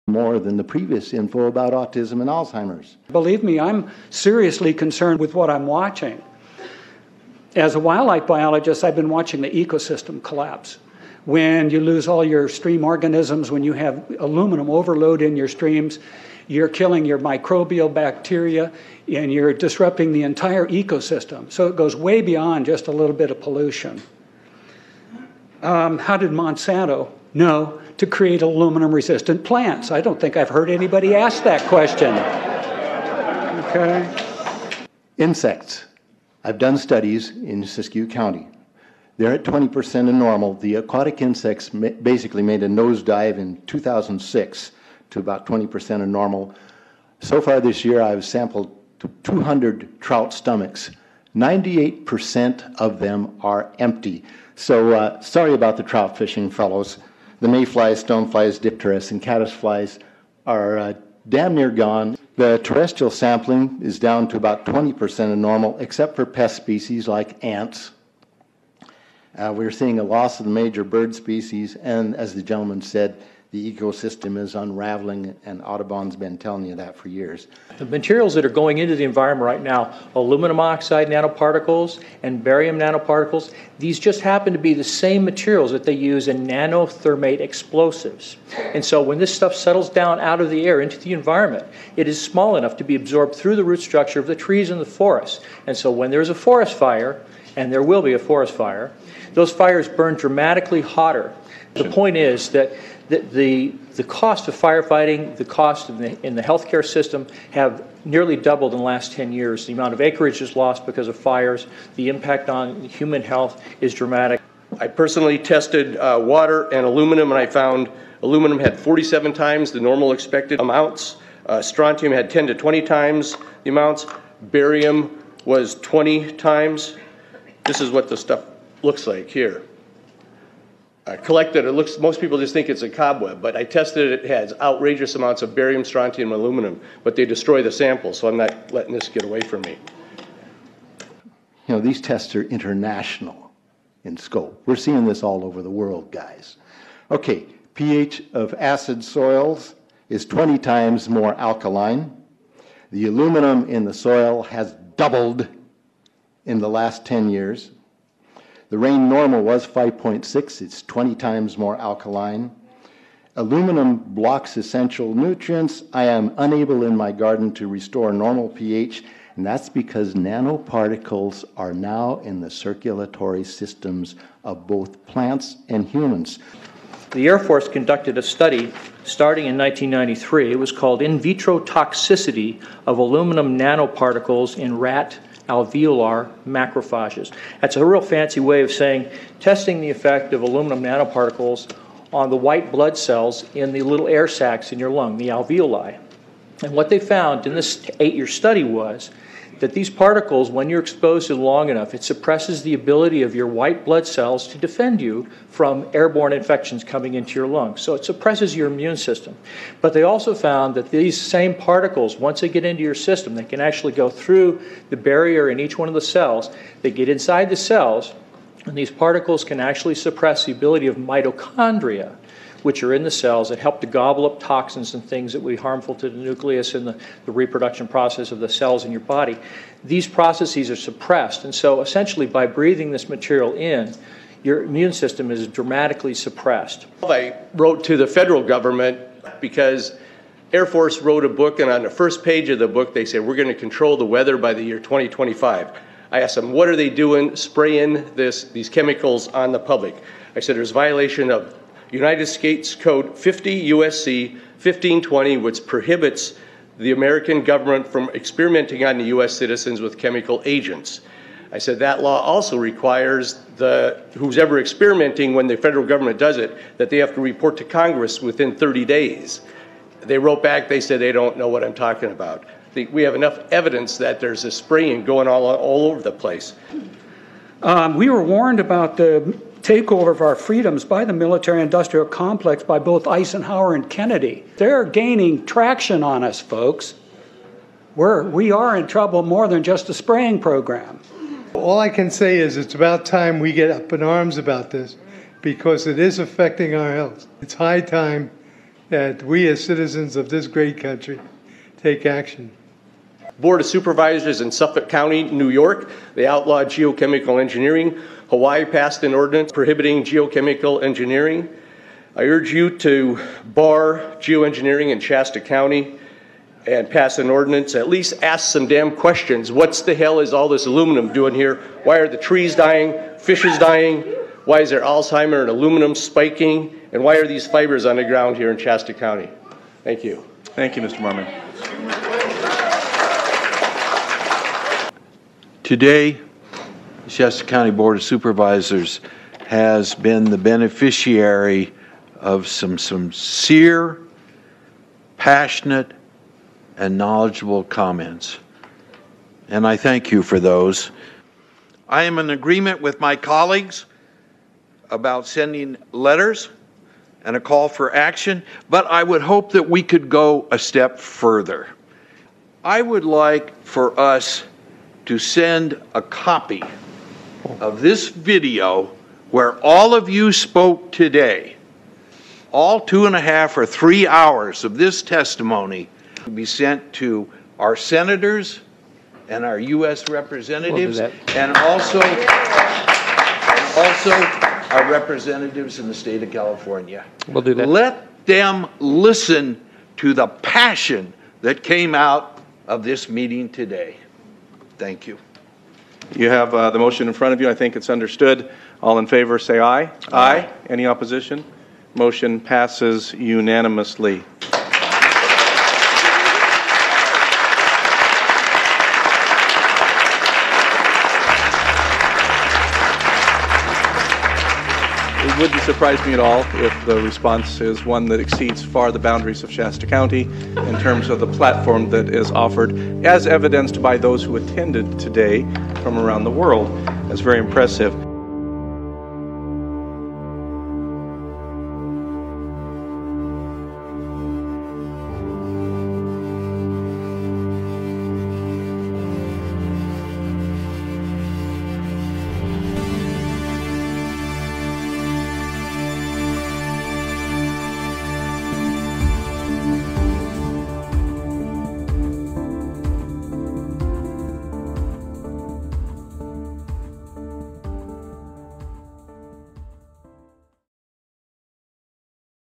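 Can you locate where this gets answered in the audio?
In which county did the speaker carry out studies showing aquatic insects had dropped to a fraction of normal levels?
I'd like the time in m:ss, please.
0:37.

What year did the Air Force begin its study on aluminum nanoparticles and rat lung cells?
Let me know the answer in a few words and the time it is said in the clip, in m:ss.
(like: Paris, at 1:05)
1993, at 2:59.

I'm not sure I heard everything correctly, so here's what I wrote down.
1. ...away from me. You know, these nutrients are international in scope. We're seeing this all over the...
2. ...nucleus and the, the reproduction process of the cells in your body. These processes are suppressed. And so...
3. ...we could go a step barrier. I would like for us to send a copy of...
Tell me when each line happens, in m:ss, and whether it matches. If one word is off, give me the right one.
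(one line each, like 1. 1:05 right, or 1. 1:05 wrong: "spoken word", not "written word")
1. 2:19 wrong: "tests", not "nutrients"
2. 3:46 right
3. 5:59 wrong: "further", not "barrier".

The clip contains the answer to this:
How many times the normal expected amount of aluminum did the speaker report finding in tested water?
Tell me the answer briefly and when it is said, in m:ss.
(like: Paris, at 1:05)
47, at 1:58.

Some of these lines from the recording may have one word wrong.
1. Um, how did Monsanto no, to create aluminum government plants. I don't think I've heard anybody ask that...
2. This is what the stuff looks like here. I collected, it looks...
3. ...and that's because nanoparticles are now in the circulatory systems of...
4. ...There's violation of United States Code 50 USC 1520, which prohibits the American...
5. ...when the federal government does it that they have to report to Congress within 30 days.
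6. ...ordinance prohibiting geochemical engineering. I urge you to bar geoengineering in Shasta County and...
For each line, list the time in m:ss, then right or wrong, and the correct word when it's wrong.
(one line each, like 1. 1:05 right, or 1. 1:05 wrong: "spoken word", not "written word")
1. 0:25 wrong: "resistant", not "government"
2. 2:07 right
3. 2:49 right
4. 4:10 right
5. 4:25 right
6. 5:09 right.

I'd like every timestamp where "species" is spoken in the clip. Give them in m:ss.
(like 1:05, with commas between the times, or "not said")
1:06, 1:11.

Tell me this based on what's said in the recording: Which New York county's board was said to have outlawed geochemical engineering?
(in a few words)
Suffolk County.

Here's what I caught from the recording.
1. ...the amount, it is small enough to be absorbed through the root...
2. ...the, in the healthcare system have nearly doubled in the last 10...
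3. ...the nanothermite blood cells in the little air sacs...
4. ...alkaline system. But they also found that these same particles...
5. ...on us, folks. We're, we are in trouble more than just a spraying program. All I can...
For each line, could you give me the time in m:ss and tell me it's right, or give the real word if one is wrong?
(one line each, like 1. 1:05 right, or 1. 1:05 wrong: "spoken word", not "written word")
1. 1:30 wrong: "environment", not "amount"
2. 1:45 right
3. 3:12 wrong: "white", not "nanothermite"
4. 3:28 wrong: "immune", not "alkaline"
5. 4:46 right.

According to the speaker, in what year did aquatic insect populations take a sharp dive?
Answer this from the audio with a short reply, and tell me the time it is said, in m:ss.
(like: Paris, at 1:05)
2006, at 0:43.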